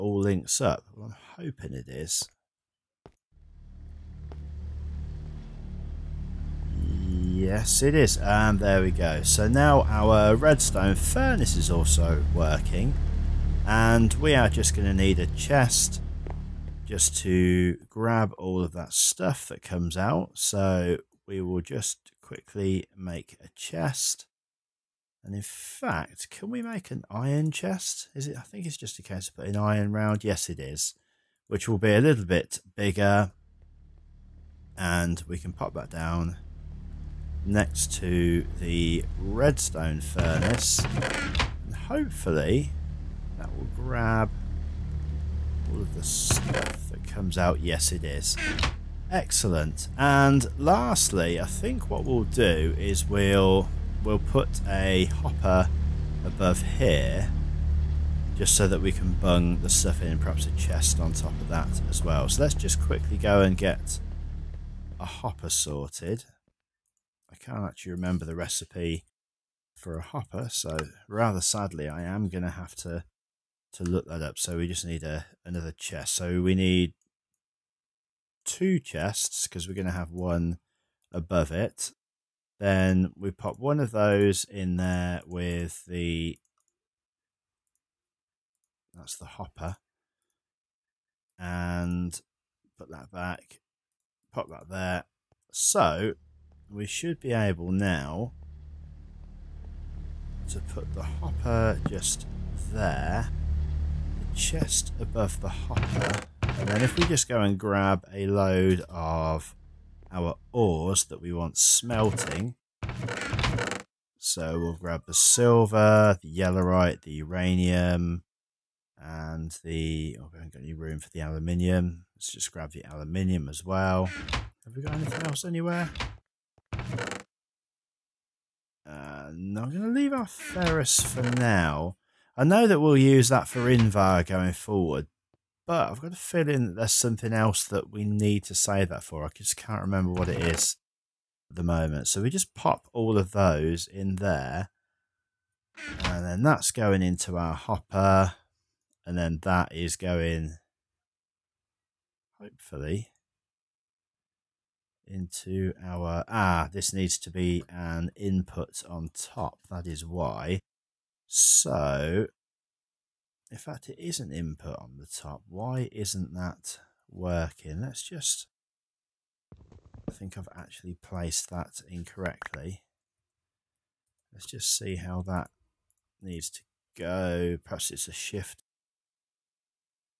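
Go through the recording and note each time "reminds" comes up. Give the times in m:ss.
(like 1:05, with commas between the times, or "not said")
not said.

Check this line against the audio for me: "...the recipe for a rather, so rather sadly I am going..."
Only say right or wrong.
wrong.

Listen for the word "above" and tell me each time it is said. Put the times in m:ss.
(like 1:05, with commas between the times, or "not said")
0:56, 1:21, 1:45.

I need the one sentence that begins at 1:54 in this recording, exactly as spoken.
So we'll grab the silver, the yellorite, the uranium, and the...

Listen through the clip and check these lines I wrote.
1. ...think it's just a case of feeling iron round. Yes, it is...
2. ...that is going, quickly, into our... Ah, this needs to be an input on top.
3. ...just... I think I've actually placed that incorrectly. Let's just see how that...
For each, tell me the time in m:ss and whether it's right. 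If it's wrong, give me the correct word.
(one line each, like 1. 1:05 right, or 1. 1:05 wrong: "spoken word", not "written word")
1. 0:28 wrong: "putting", not "feeling"
2. 2:29 wrong: "hopefully", not "quickly"
3. 2:48 right.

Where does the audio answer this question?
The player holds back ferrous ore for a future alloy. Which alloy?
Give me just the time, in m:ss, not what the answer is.
2:13.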